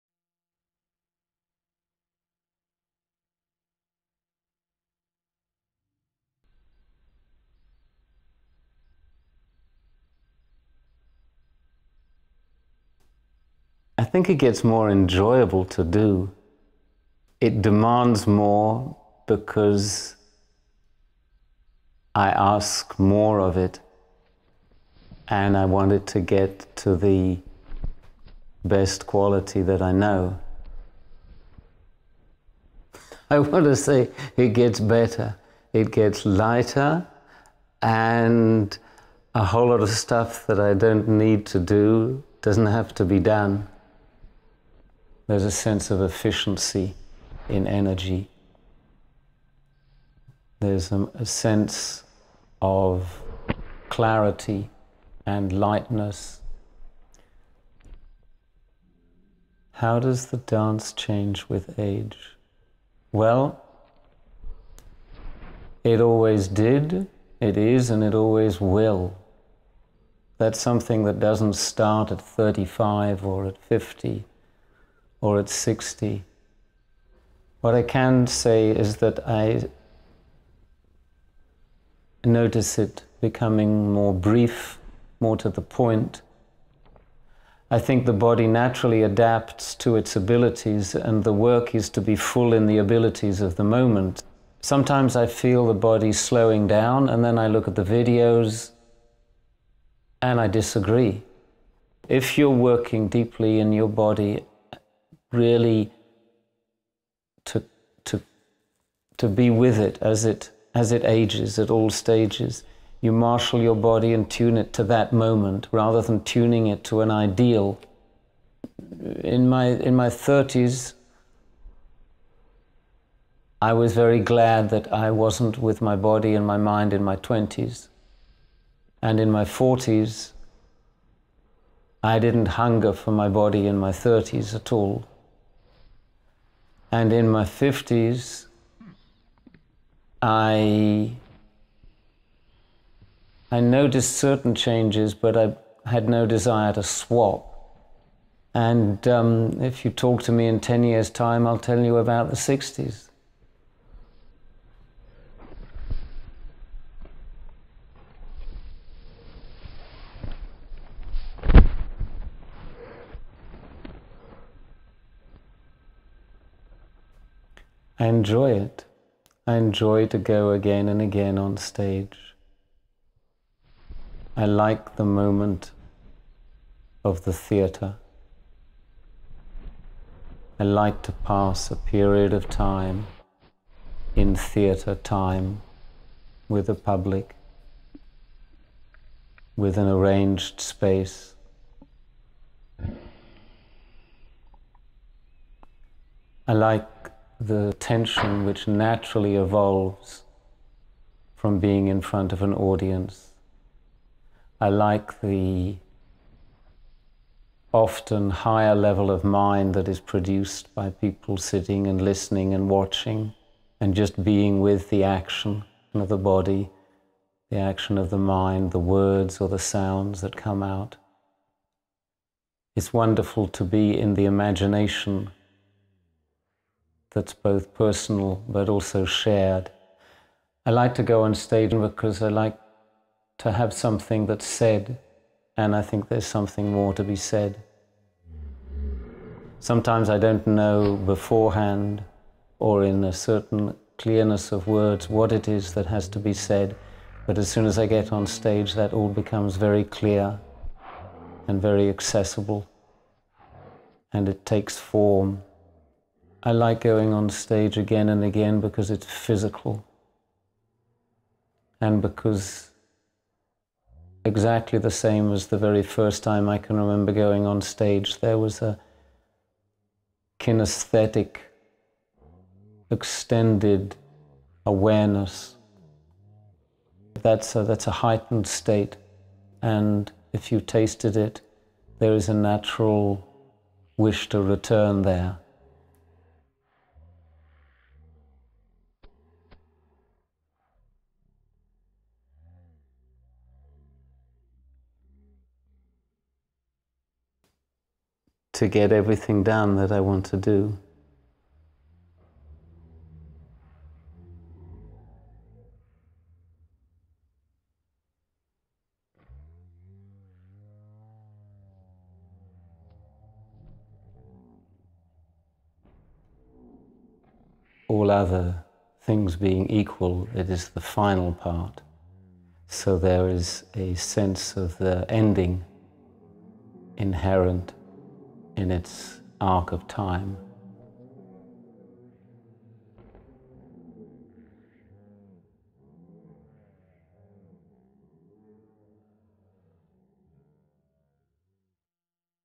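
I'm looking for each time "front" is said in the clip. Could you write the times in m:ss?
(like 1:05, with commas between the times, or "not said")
3:21.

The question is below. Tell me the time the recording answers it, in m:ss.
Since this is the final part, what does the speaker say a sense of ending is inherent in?
5:28.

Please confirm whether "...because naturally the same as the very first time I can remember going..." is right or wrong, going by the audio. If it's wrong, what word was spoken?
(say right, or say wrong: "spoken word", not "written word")
wrong: "exactly", not "naturally".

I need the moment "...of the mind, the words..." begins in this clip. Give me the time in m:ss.
3:37.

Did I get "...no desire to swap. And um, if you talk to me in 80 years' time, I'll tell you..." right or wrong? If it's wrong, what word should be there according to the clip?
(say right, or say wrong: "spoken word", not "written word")
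wrong: "10", not "80".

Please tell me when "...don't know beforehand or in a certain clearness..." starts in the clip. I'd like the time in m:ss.
4:00.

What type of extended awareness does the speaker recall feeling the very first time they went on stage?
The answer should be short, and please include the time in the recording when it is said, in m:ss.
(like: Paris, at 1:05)
kinesthetic, at 4:30.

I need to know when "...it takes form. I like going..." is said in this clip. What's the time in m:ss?
4:14.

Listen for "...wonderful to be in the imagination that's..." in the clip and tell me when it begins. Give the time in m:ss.
3:42.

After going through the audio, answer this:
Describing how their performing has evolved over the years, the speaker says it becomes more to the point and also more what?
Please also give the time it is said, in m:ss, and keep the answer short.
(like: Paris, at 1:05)
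brief, at 1:24.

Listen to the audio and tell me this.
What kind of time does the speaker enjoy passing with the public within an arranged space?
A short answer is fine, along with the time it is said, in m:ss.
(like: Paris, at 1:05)
theatre time, at 3:04.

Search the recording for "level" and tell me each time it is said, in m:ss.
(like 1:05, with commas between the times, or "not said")
3:28.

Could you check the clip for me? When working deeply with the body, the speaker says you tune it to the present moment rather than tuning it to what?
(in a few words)
an ideal.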